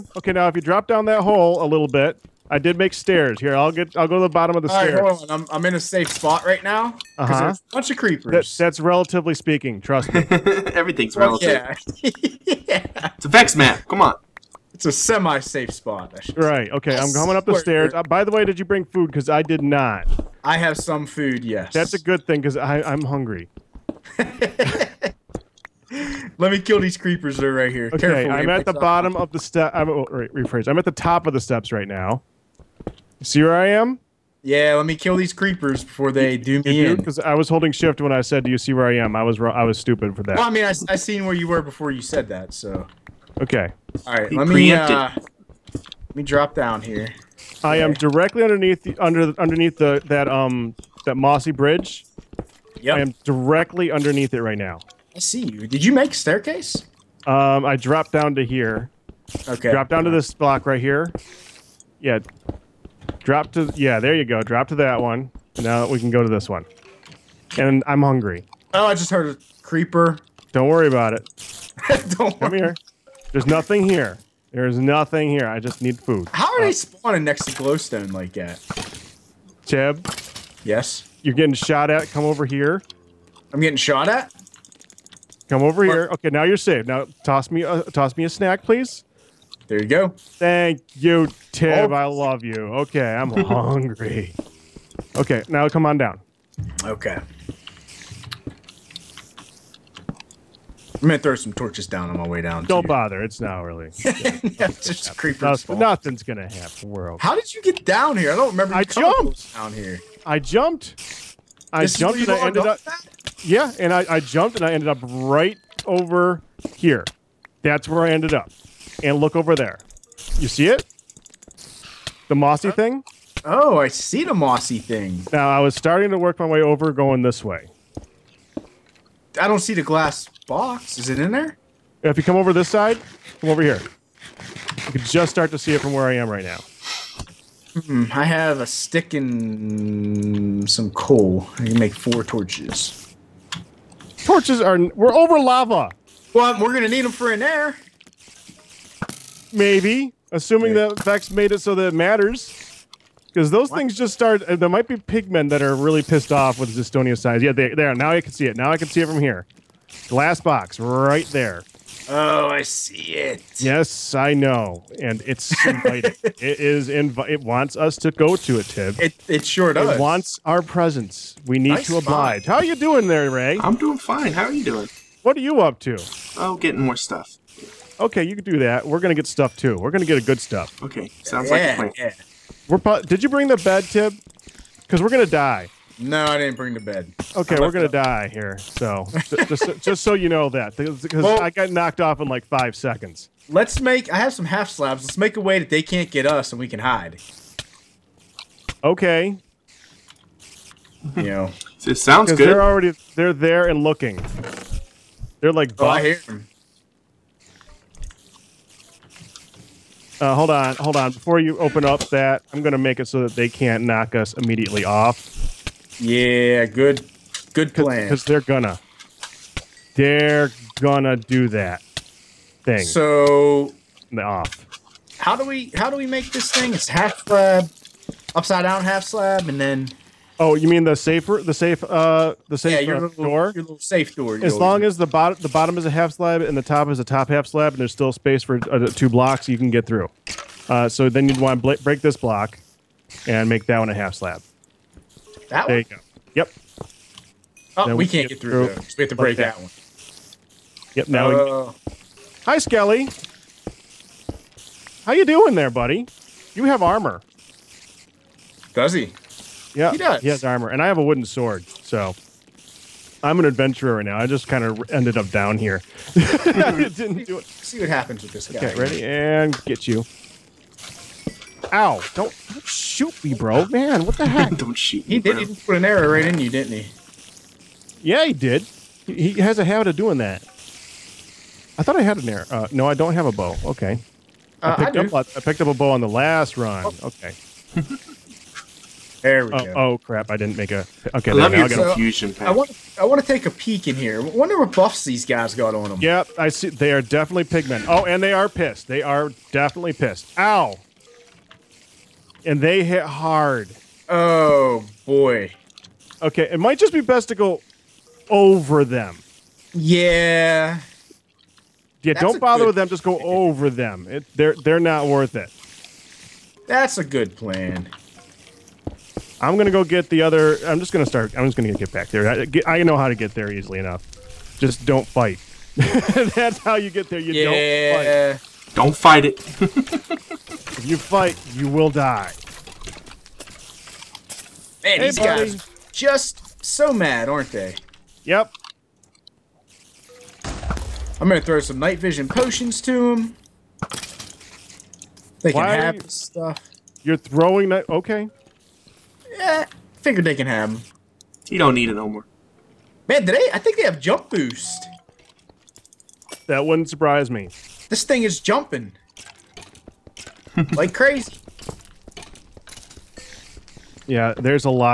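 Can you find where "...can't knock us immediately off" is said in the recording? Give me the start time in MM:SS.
03:33.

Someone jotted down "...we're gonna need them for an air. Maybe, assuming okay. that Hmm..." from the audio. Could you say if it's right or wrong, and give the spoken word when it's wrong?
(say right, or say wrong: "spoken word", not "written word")
wrong: "Vechs", not "Hmm".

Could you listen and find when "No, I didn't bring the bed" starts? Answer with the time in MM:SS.
03:05.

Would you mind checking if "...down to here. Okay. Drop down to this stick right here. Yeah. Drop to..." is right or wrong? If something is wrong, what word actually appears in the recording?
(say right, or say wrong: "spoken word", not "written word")
wrong: "block", not "stick".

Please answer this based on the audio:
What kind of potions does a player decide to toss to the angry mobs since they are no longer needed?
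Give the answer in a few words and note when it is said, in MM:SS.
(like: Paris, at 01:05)
night vision potions, at 05:41.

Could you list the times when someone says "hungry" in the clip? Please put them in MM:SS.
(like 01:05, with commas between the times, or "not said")
00:23, 01:08, 01:33.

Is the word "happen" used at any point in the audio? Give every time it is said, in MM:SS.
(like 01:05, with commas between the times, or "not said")
01:46, 04:27.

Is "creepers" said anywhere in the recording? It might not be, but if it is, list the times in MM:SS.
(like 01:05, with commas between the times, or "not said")
00:07, 00:26, 00:35, 01:09, 01:45.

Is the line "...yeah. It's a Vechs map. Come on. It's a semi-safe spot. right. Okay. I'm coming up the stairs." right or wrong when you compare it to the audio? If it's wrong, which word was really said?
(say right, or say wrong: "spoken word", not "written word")
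right.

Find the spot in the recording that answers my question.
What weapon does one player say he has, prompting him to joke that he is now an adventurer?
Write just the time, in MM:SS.
04:21.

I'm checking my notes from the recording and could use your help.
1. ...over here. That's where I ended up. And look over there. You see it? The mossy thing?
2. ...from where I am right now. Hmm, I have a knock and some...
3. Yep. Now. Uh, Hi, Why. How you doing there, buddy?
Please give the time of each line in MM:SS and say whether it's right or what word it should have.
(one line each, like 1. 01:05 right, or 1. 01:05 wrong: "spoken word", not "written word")
1. 01:55 right
2. 02:15 wrong: "stick", not "knock"
3. 04:10 wrong: "Skelly", not "Why".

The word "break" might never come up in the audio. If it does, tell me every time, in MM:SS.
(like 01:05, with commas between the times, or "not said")
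04:01, 04:09.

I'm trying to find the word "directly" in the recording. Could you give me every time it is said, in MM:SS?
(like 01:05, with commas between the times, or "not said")
00:47, 00:53.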